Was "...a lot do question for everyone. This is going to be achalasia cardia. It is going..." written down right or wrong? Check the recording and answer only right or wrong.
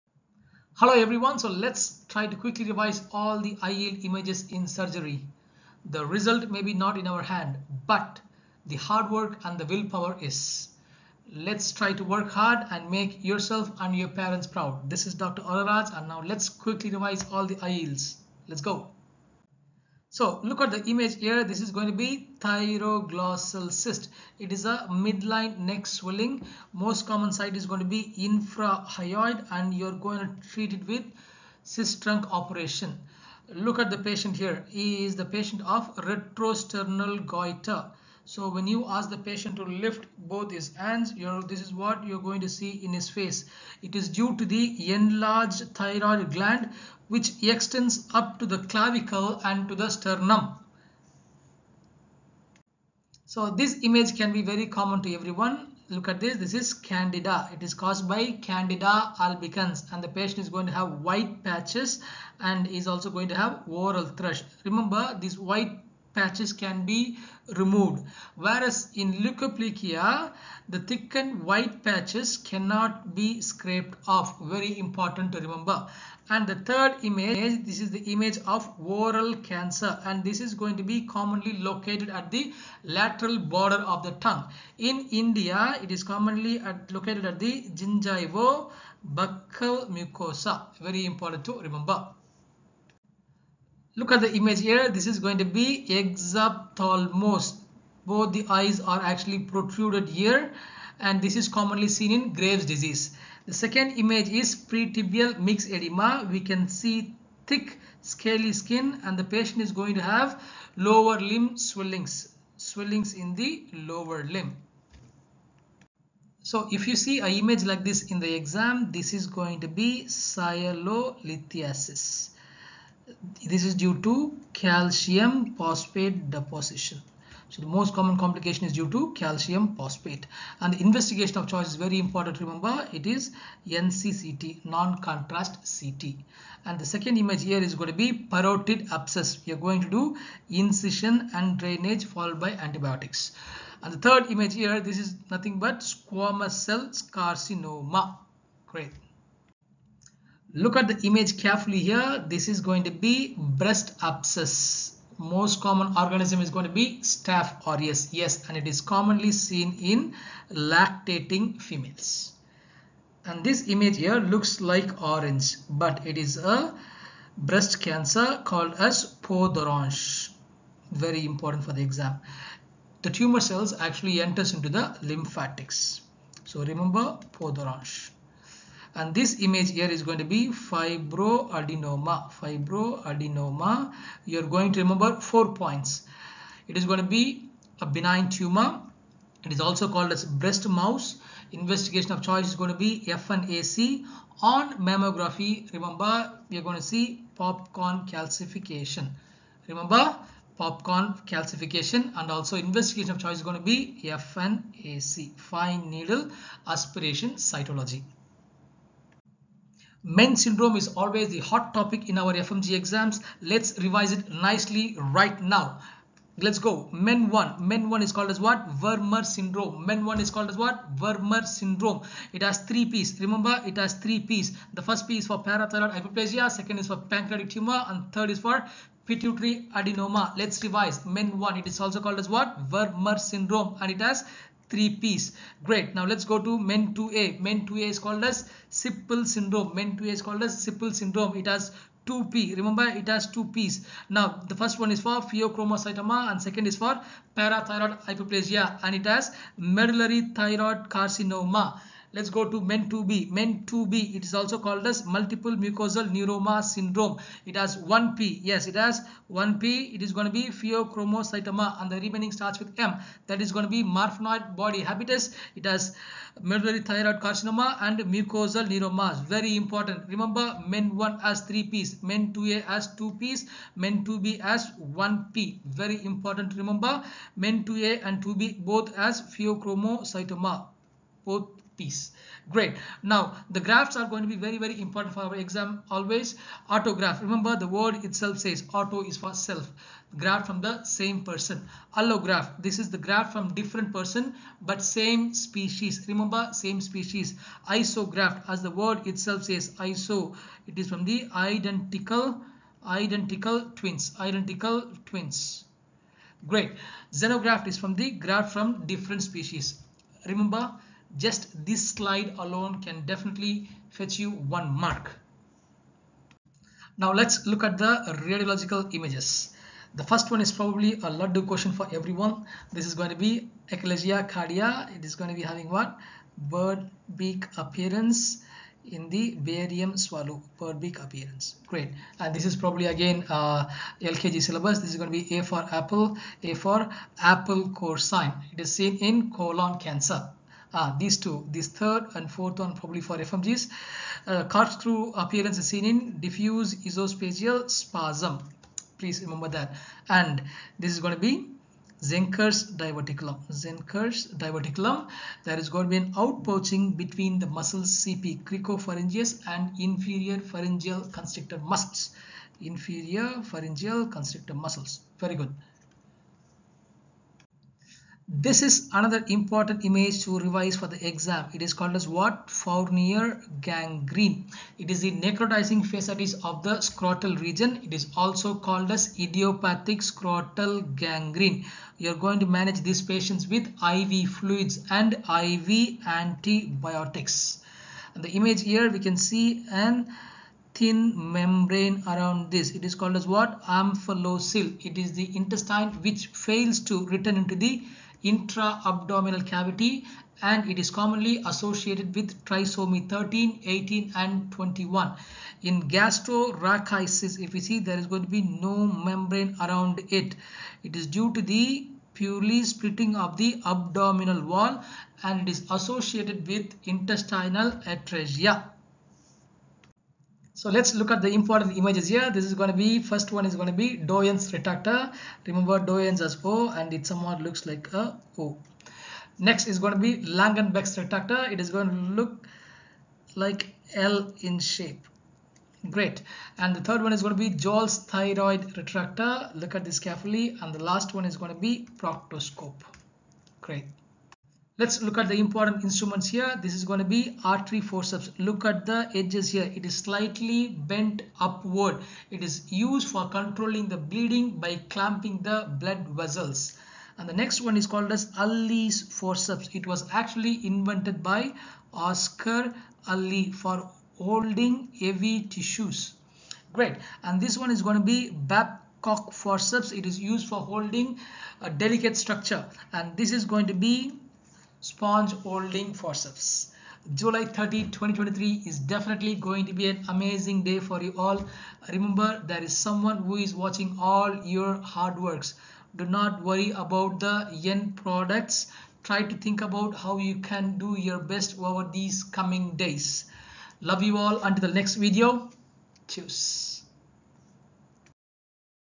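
right.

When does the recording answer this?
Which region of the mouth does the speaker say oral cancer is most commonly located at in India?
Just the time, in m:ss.
1:27.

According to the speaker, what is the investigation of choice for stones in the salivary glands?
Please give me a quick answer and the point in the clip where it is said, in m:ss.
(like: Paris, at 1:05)
NCCT, at 2:13.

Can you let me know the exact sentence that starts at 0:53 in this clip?
So this image can be very common to everyone.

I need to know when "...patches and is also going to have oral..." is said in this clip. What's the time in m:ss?
1:01.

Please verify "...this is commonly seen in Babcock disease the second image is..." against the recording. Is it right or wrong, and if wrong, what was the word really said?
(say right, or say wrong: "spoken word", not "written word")
wrong: "Graves", not "Babcock".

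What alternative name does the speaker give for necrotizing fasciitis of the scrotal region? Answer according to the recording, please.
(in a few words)
Idiopathic scrotal gangrene.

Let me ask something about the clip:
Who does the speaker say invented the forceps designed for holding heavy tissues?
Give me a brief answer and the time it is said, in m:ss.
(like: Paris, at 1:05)
Oscar Allis, at 7:41.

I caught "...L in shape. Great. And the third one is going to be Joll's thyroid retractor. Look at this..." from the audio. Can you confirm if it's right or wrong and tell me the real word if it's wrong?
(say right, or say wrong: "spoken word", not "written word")
right.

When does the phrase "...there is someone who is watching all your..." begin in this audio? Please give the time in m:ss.
8:02.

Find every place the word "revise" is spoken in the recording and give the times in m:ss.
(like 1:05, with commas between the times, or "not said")
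0:02, 0:16, 3:33, 3:50, 6:10.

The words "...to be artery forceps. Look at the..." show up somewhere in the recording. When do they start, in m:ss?
7:26.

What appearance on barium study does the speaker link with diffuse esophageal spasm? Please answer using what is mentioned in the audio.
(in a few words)
Corkscrew appearance.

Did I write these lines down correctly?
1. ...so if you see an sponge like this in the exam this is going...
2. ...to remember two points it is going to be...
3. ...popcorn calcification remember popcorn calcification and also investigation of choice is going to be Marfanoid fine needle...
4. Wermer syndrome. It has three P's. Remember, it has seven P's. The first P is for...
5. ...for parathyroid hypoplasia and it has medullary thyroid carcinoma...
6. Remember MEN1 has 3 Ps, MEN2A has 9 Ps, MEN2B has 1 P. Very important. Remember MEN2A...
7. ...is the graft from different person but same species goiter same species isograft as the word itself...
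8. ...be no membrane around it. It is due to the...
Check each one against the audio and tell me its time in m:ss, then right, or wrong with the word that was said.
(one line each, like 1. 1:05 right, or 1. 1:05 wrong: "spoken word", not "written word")
1. 1:56 wrong: "image", not "sponge"
2. 3:04 wrong: "four", not "two"
3. 3:17 wrong: "FNAC", not "Marfanoid"
4. 3:40 wrong: "three", not "seven"
5. 4:06 right
6. 4:30 wrong: "2", not "9"
7. 4:52 wrong: "remember", not "goiter"
8. 6:48 right.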